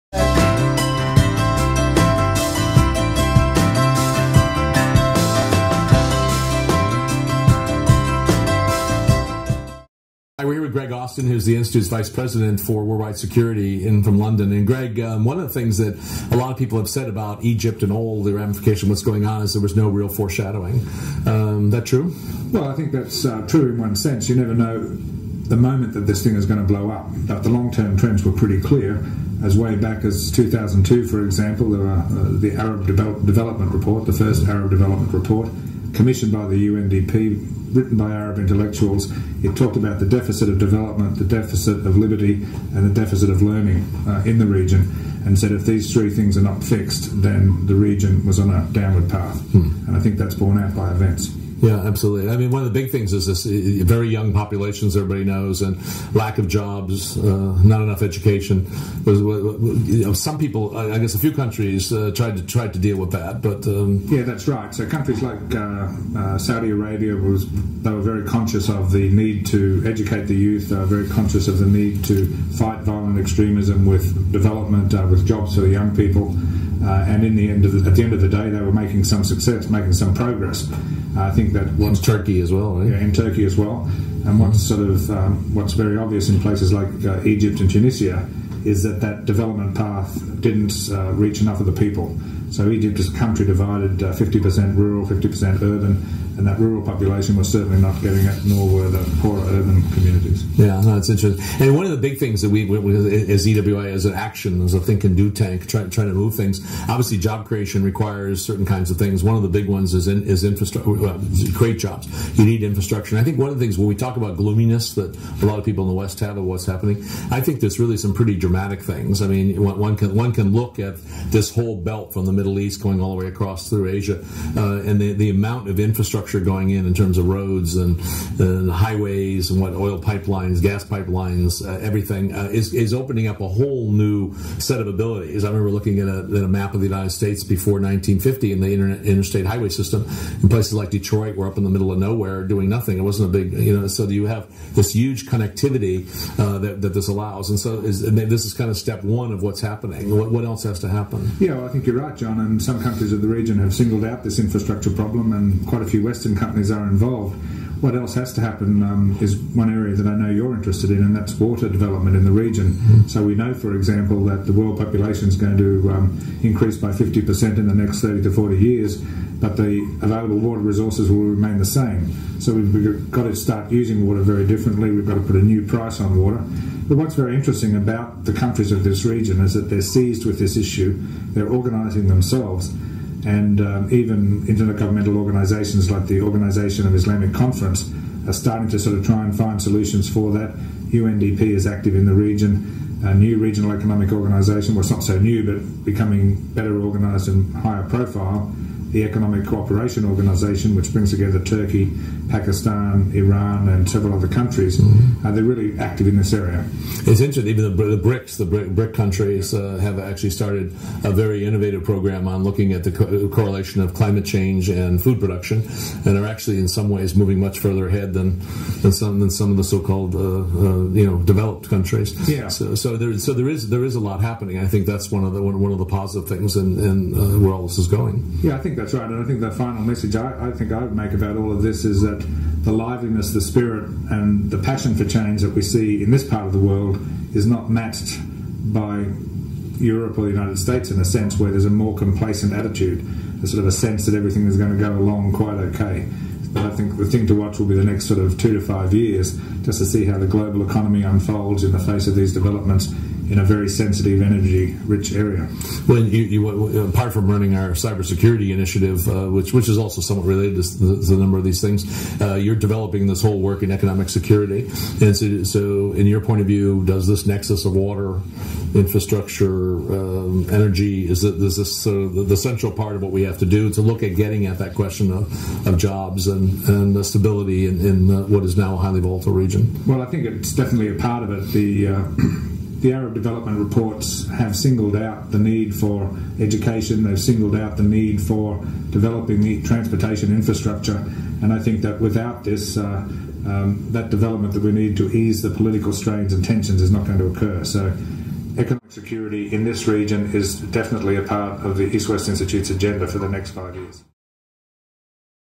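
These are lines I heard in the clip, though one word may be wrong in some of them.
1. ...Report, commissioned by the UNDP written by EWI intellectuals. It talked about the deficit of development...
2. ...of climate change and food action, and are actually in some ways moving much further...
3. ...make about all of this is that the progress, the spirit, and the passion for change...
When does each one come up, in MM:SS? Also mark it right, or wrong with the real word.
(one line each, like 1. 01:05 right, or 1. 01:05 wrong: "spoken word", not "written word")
1. 00:35 wrong: "Arab", not "EWI"
2. 03:33 wrong: "production", not "action"
3. 03:50 wrong: "liveliness", not "progress".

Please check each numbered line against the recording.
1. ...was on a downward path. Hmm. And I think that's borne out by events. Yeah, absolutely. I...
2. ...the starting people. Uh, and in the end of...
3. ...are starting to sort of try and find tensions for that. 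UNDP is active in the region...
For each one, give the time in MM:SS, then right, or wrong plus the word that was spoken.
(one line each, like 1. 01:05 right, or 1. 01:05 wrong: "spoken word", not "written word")
1. 00:48 right
2. 01:15 wrong: "young", not "starting"
3. 03:08 wrong: "solutions", not "tensions".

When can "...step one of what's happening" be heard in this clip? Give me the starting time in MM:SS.
02:28.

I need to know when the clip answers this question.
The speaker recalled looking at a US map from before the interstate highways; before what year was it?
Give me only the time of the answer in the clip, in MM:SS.
02:17.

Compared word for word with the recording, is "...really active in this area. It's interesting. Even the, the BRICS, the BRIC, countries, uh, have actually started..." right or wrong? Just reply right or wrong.
right.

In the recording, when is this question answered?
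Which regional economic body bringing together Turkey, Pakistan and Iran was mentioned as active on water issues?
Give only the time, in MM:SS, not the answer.
03:19.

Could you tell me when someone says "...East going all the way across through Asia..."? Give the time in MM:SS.
02:02.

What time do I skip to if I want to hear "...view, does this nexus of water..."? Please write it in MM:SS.
04:26.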